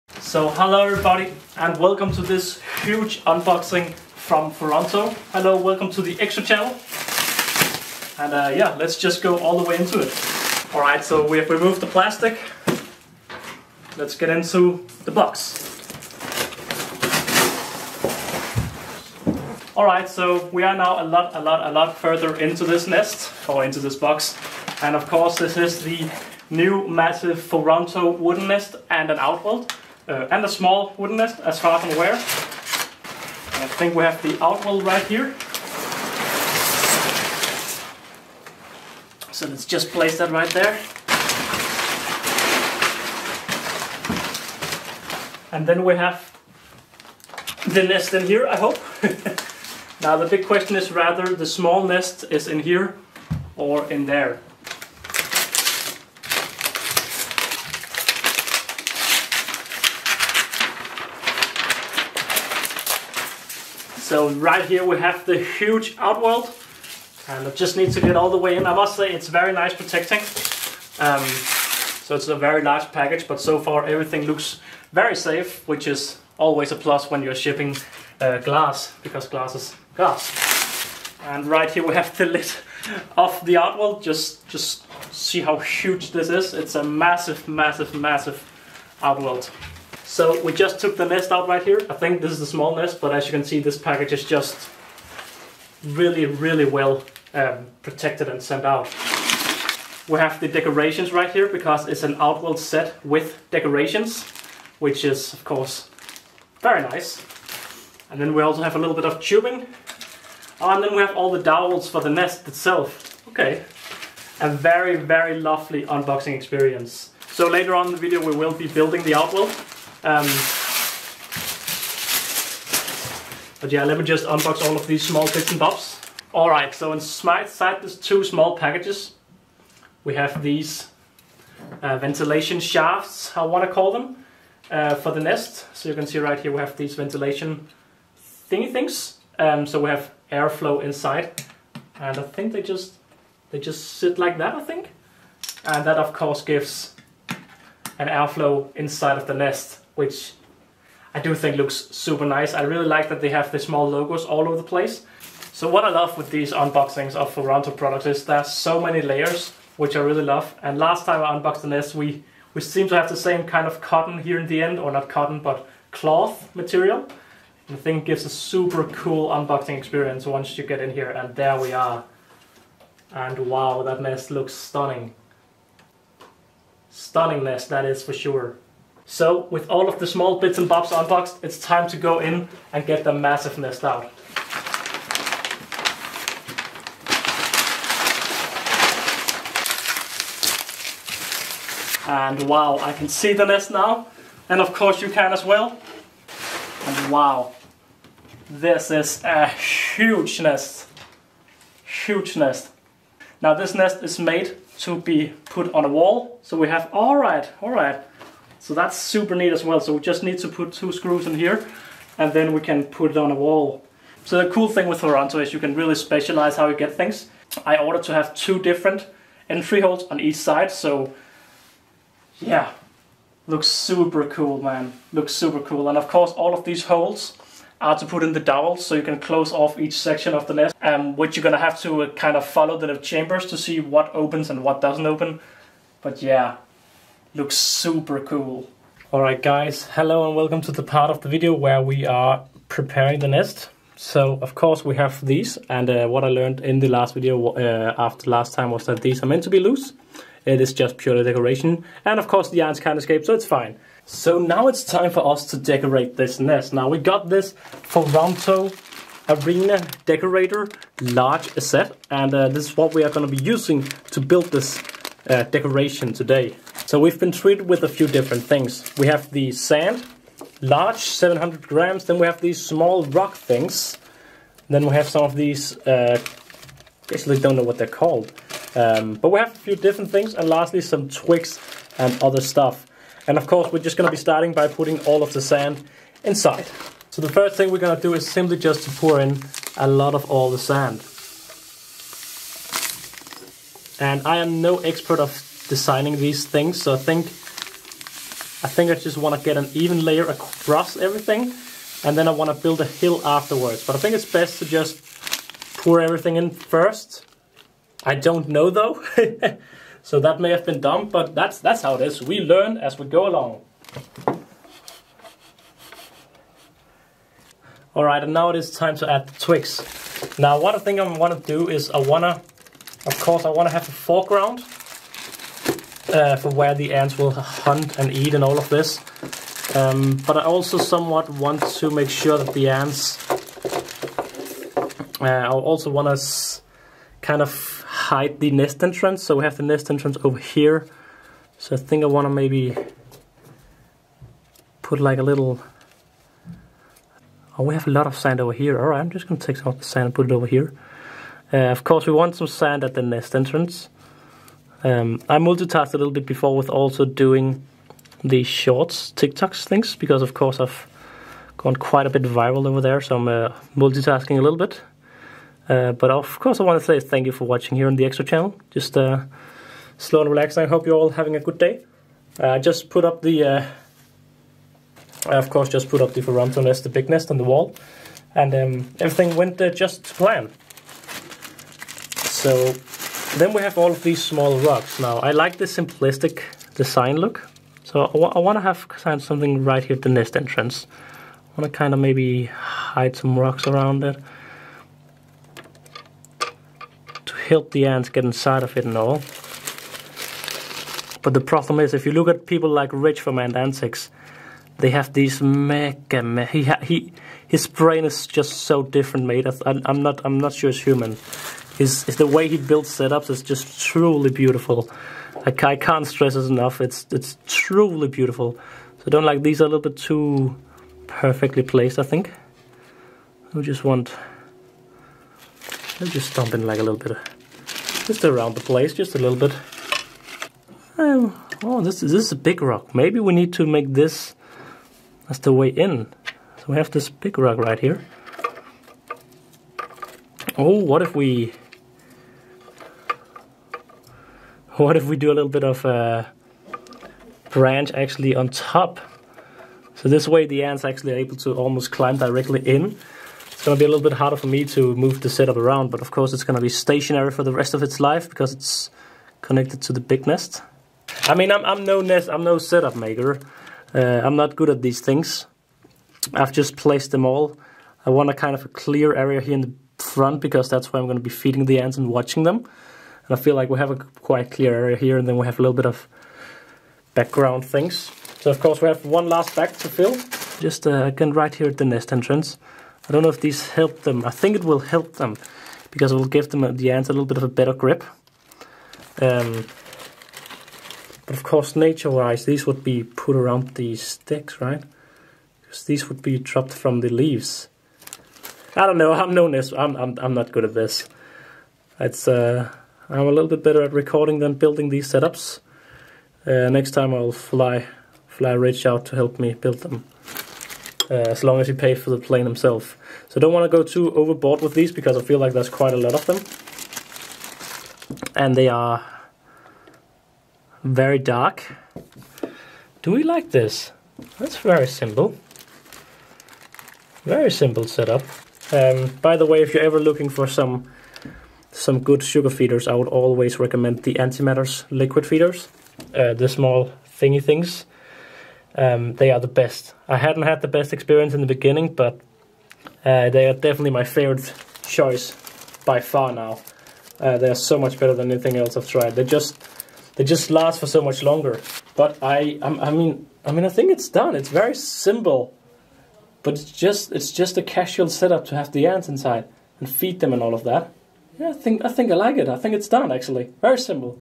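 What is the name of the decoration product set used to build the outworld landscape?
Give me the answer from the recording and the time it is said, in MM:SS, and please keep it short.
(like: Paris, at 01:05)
Foranto Arena Decorator, at 04:17.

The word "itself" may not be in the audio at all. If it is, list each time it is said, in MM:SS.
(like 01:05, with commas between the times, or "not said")
01:52.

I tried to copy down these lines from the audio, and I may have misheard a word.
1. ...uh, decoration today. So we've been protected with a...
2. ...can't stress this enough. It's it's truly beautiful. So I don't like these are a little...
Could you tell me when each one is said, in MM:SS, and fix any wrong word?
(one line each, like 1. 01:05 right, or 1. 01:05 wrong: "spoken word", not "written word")
1. 04:25 wrong: "treated", not "protected"
2. 06:55 right.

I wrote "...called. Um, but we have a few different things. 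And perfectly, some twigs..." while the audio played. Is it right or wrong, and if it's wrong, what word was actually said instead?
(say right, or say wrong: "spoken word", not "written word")
wrong: "lastly", not "perfectly".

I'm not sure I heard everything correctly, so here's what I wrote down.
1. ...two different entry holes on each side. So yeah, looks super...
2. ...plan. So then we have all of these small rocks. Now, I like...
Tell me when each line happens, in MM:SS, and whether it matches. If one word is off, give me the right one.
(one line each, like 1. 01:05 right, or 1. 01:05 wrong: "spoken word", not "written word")
1. 03:38 right
2. 06:20 right.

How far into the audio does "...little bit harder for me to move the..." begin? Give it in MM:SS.
07:33.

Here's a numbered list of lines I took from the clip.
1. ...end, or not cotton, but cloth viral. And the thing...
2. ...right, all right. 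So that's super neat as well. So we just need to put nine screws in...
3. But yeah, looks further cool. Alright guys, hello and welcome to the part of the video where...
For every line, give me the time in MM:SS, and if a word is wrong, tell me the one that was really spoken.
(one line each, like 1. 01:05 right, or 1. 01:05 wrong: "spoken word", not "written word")
1. 02:44 wrong: "material", not "viral"
2. 03:27 wrong: "two", not "nine"
3. 03:56 wrong: "super", not "further".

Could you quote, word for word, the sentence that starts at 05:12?
We learn as we go along.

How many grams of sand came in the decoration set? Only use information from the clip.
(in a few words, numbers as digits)
700.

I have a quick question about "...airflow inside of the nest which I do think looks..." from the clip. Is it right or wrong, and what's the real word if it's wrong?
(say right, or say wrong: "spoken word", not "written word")
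right.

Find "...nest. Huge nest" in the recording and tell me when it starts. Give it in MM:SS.
03:20.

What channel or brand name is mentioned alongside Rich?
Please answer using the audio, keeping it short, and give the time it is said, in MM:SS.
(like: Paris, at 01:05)
Ant Antics, at 06:43.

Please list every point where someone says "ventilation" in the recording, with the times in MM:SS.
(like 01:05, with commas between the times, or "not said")
02:11, 02:16.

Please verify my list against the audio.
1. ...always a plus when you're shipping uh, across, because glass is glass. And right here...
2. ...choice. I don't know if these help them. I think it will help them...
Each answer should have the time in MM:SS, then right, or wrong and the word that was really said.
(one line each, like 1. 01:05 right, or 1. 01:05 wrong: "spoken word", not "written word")
1. 01:16 wrong: "glass", not "across"
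2. 08:02 wrong: "entrance", not "choice".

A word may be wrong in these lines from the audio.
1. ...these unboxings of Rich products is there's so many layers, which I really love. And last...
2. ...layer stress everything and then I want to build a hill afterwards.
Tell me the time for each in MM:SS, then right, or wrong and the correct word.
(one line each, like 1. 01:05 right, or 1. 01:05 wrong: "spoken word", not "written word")
1. 02:36 wrong: "Foranto", not "Rich"
2. 05:00 wrong: "across", not "stress".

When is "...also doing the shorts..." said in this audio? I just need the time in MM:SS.
05:56.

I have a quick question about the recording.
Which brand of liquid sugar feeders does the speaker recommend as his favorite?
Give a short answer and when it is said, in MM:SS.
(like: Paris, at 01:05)
Antimatters, at 08:54.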